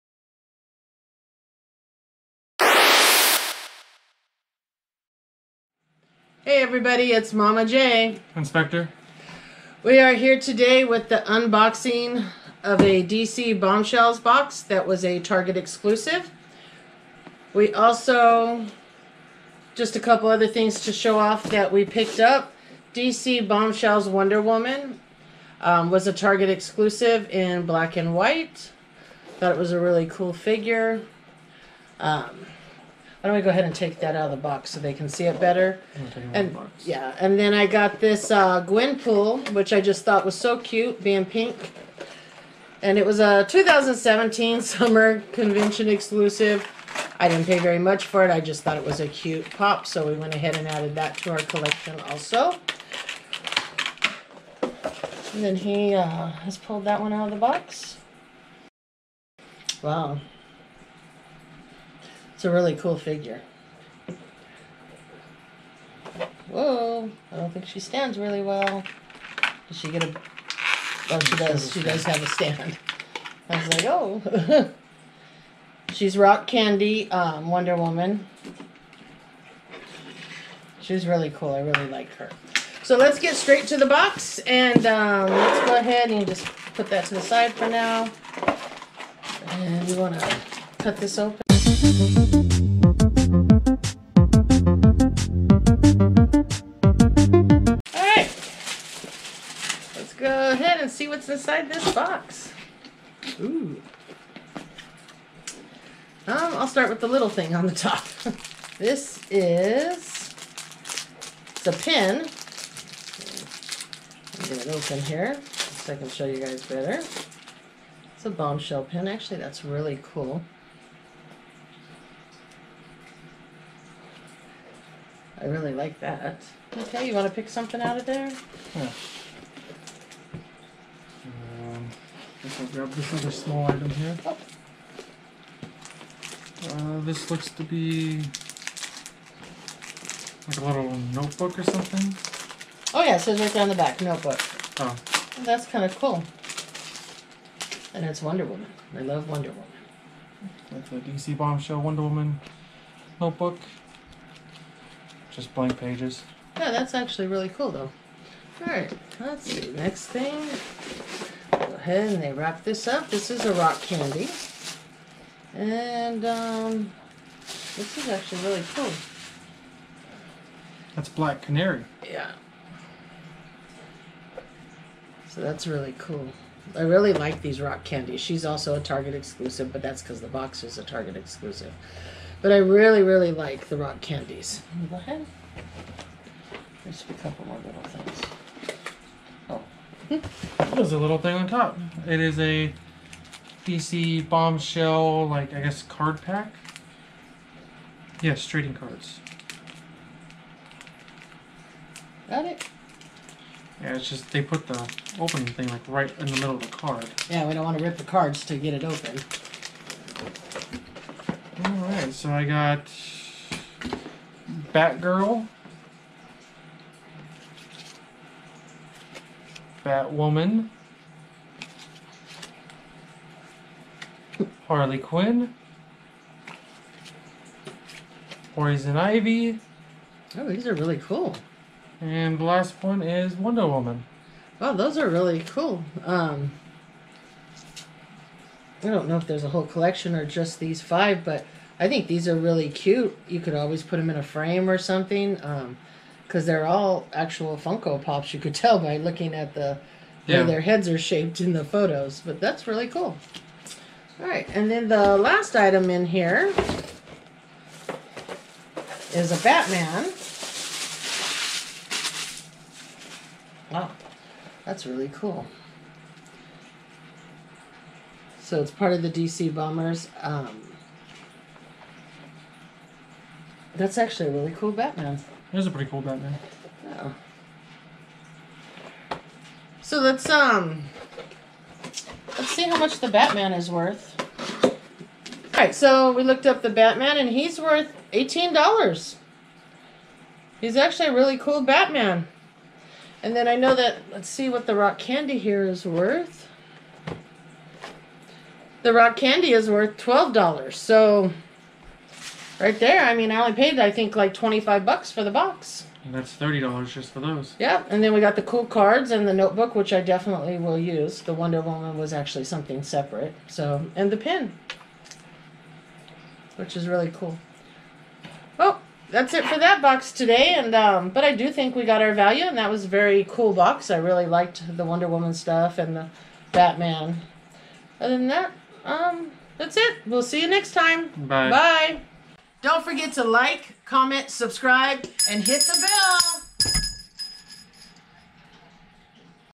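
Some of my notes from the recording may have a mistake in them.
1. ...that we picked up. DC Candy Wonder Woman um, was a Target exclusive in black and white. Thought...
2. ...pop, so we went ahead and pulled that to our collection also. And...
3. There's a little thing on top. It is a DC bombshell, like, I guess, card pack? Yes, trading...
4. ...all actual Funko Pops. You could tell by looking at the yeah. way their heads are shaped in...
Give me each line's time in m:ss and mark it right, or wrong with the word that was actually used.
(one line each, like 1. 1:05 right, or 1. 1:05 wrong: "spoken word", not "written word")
1. 0:21 wrong: "Bombshells", not "Candy"
2. 0:49 wrong: "added", not "pulled"
3. 3:10 right
4. 4:06 right.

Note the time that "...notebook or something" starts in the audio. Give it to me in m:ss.
2:21.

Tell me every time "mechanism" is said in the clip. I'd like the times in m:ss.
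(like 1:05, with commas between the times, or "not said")
not said.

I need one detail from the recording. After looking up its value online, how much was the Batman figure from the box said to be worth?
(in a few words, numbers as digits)
$18.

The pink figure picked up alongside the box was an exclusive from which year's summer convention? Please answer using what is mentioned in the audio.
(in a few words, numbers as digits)
2017.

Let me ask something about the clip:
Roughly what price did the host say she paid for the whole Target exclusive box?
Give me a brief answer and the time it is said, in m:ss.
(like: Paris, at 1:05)
$25, at 5:04.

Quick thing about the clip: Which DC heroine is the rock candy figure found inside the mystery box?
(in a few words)
Black Canary.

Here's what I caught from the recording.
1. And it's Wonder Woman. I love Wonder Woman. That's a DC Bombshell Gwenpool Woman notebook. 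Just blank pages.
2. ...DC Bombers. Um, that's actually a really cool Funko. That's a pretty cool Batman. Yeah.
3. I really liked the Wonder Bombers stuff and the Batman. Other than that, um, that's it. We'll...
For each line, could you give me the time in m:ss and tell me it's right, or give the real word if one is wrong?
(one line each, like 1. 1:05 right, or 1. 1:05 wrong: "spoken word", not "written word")
1. 2:27 wrong: "Wonder", not "Gwenpool"
2. 4:29 wrong: "Batman", not "Funko"
3. 5:23 wrong: "Woman", not "Bombers".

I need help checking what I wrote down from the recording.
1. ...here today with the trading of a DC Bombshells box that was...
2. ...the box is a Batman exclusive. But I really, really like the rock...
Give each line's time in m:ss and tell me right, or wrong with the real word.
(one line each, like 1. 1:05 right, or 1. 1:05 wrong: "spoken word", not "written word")
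1. 0:10 wrong: "unboxing", not "trading"
2. 3:00 wrong: "Target", not "Batman".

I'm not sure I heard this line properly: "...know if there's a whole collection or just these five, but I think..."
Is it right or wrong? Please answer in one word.
right.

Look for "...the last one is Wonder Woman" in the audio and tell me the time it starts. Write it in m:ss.
3:52.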